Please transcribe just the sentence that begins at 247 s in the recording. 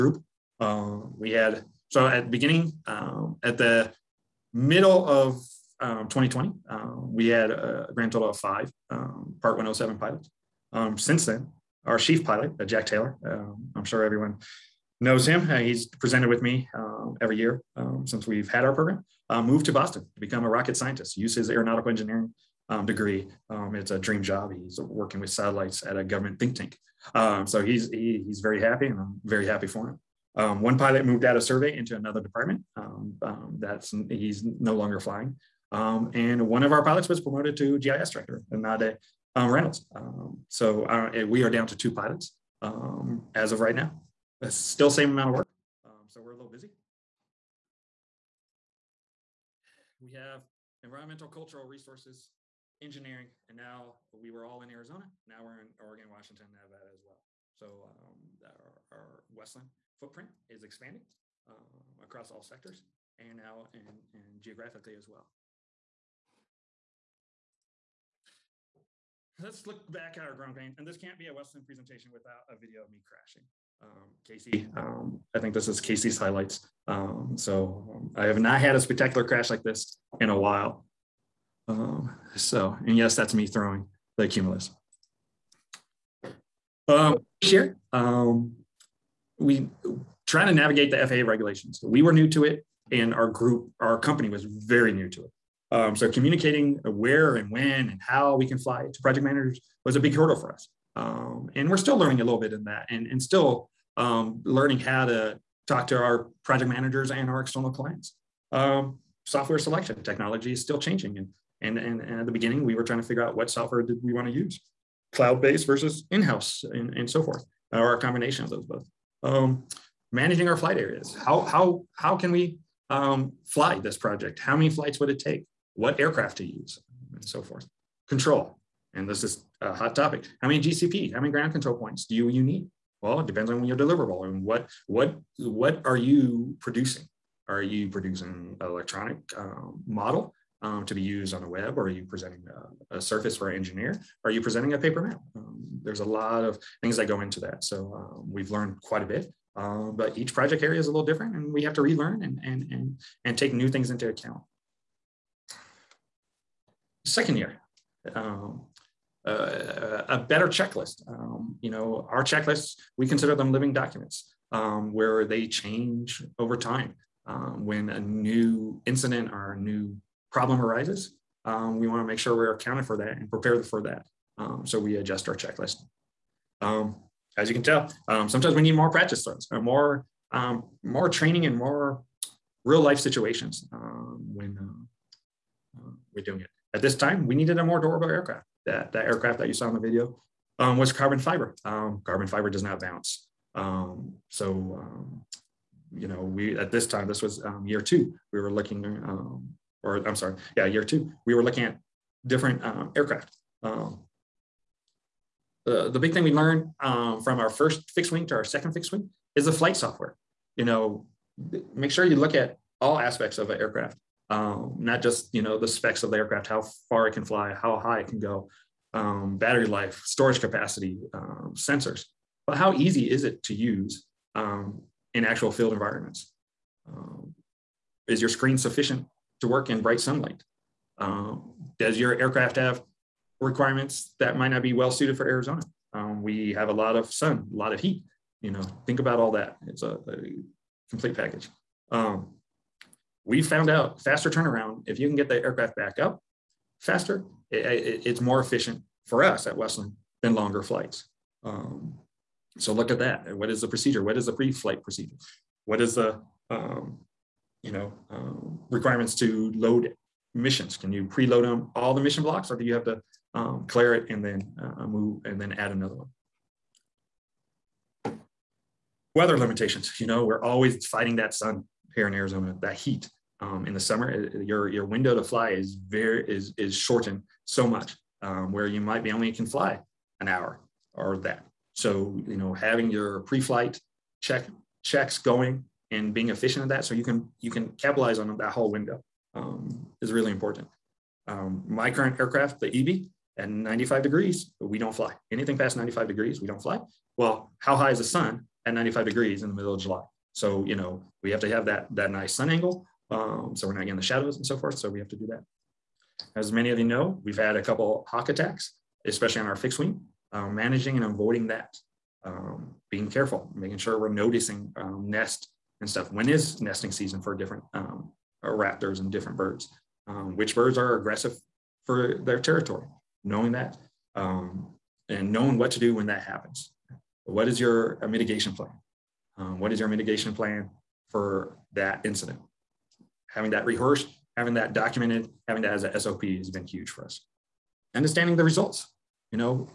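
It, it, it's more efficient for us at WestLand than longer flights.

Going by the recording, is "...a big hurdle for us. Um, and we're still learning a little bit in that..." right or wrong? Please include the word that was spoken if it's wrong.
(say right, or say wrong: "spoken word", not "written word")
right.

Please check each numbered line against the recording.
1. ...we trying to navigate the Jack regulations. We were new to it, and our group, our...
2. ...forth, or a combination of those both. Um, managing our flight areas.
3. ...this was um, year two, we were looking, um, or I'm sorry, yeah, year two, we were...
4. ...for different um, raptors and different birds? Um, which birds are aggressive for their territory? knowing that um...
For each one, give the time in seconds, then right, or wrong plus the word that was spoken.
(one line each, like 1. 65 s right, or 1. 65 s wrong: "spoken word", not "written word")
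1. 89 s wrong: "FAA", not "Jack"
2. 117 s right
3. 197 s right
4. 317 s right.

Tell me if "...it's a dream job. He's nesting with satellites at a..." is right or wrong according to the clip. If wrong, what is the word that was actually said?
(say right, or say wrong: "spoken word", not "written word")
wrong: "working", not "nesting".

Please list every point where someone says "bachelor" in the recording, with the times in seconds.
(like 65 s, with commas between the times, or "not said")
not said.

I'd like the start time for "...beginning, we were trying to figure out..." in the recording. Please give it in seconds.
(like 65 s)
112 s.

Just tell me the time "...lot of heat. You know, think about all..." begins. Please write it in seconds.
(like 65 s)
237 s.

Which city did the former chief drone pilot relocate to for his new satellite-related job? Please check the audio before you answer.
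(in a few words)
Boston.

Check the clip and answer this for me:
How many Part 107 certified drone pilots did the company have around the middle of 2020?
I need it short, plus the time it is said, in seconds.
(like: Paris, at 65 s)
5, at 8 s.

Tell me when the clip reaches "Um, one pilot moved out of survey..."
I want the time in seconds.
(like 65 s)
30 s.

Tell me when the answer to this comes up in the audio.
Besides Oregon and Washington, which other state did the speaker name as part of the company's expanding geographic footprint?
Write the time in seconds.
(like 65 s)
56 s.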